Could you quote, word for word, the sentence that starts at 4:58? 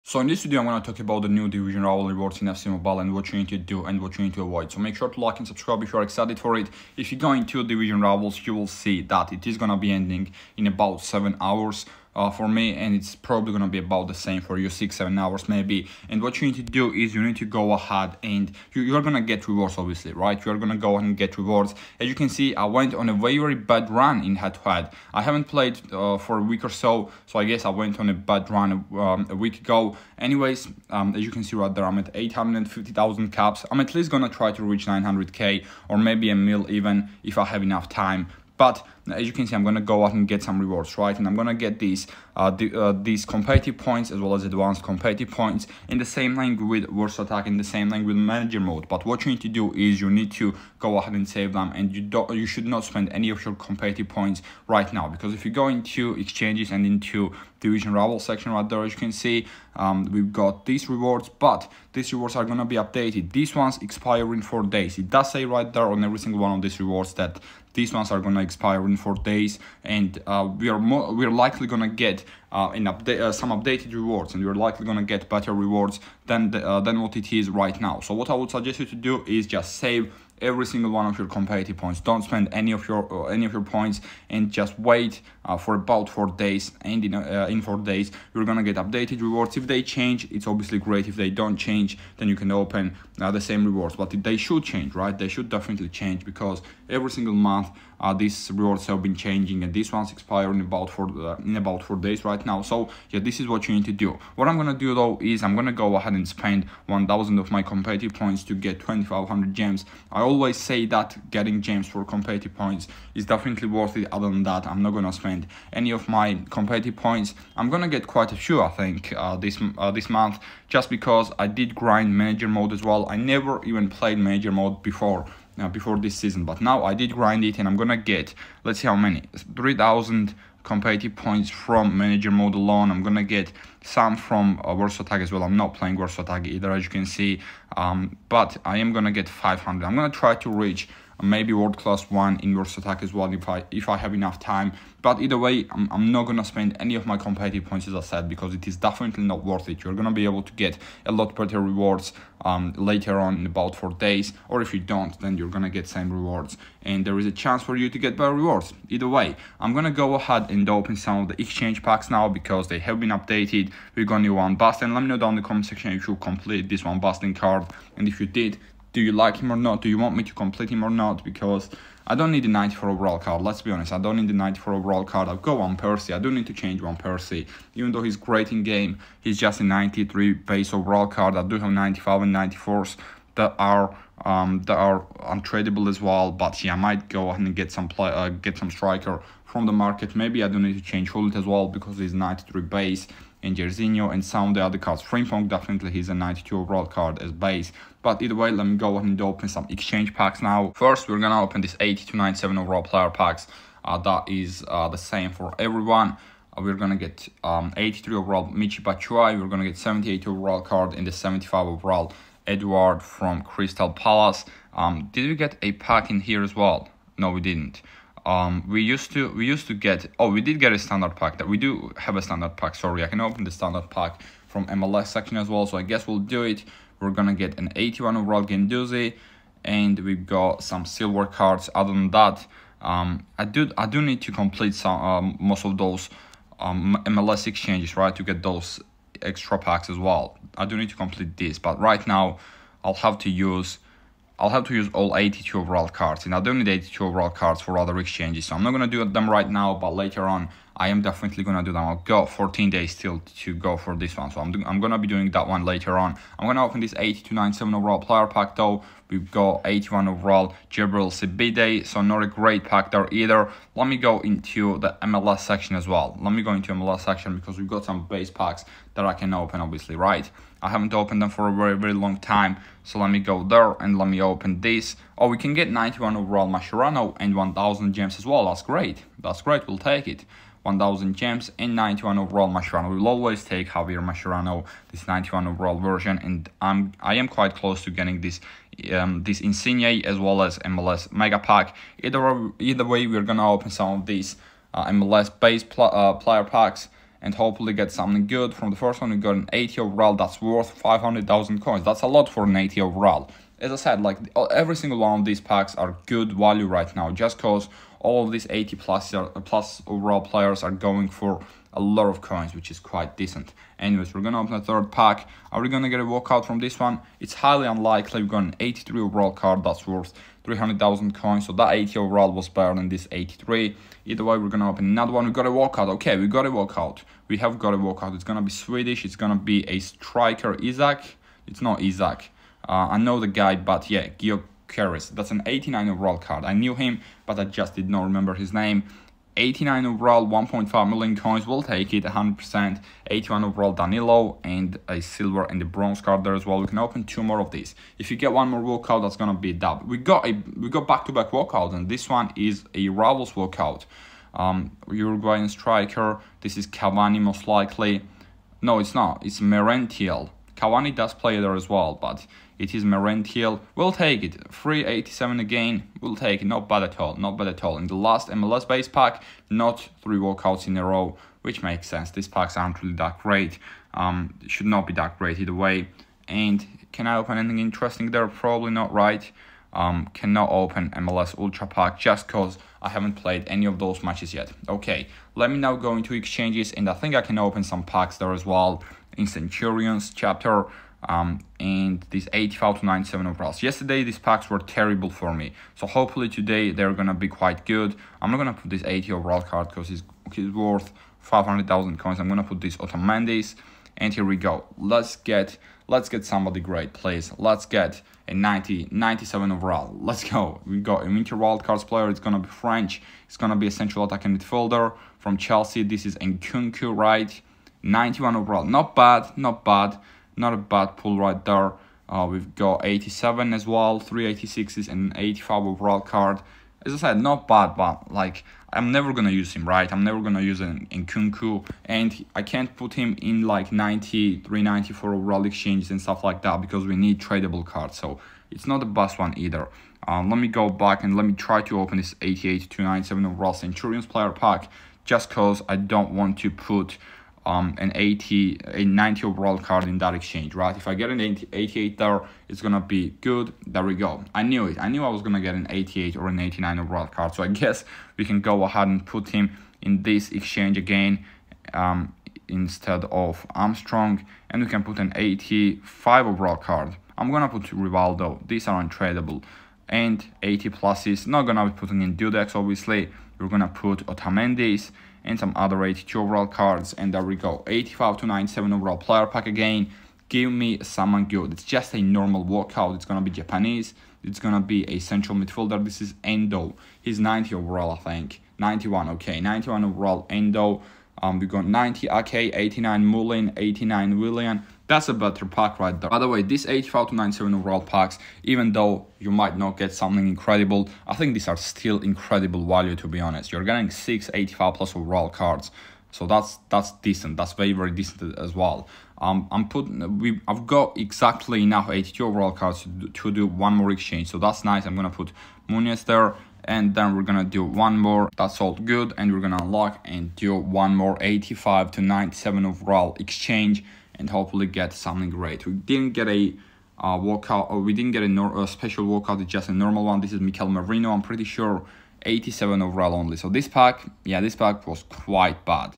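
From the first one, we got an 80 overall that's worth 500,000 coins.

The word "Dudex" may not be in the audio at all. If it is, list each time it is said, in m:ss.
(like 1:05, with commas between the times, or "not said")
7:52.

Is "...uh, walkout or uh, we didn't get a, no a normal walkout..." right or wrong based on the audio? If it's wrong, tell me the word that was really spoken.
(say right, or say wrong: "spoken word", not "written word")
wrong: "special", not "normal".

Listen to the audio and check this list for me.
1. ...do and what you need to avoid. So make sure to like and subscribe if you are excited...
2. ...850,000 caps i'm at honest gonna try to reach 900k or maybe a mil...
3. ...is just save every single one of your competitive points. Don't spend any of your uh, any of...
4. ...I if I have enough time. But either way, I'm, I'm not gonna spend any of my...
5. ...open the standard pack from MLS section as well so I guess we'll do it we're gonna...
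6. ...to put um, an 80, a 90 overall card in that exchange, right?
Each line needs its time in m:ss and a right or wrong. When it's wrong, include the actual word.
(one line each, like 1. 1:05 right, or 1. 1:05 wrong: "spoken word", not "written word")
1. 0:03 right
2. 0:32 wrong: "least", not "honest"
3. 1:19 right
4. 2:23 right
5. 3:43 right
6. 7:26 right.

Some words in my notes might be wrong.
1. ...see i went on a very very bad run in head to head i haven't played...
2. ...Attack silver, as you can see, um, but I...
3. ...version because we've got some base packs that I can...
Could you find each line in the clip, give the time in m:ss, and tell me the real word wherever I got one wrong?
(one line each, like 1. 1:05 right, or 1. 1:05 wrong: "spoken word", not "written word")
1. 0:22 right
2. 2:16 wrong: "either", not "silver"
3. 4:27 wrong: "section", not "version".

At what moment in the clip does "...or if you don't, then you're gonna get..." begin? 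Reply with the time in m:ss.
2:34.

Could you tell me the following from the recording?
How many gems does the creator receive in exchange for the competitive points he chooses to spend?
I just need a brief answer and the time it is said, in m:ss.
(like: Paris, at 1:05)
2,500, at 1:48.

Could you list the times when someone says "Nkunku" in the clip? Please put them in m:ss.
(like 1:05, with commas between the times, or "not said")
6:56, 7:10.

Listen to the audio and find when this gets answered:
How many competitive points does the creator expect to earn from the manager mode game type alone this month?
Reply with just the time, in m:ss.
2:09.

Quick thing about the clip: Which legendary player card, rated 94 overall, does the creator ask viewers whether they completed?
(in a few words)
Van Basten.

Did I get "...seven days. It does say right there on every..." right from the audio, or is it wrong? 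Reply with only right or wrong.
wrong.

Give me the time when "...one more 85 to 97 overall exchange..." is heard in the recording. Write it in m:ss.
8:40.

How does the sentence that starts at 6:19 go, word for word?
Um, cannot open MLS Ultra Pack just because I haven't played any of those matches yet.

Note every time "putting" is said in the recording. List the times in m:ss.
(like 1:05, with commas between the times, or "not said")
7:51, 8:29.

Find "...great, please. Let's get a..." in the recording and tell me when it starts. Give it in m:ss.
6:46.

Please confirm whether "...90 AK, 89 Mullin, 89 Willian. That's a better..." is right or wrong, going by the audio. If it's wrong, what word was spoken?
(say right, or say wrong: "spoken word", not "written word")
right.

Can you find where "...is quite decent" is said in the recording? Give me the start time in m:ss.
5:12.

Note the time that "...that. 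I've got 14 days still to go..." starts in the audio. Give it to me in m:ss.
4:11.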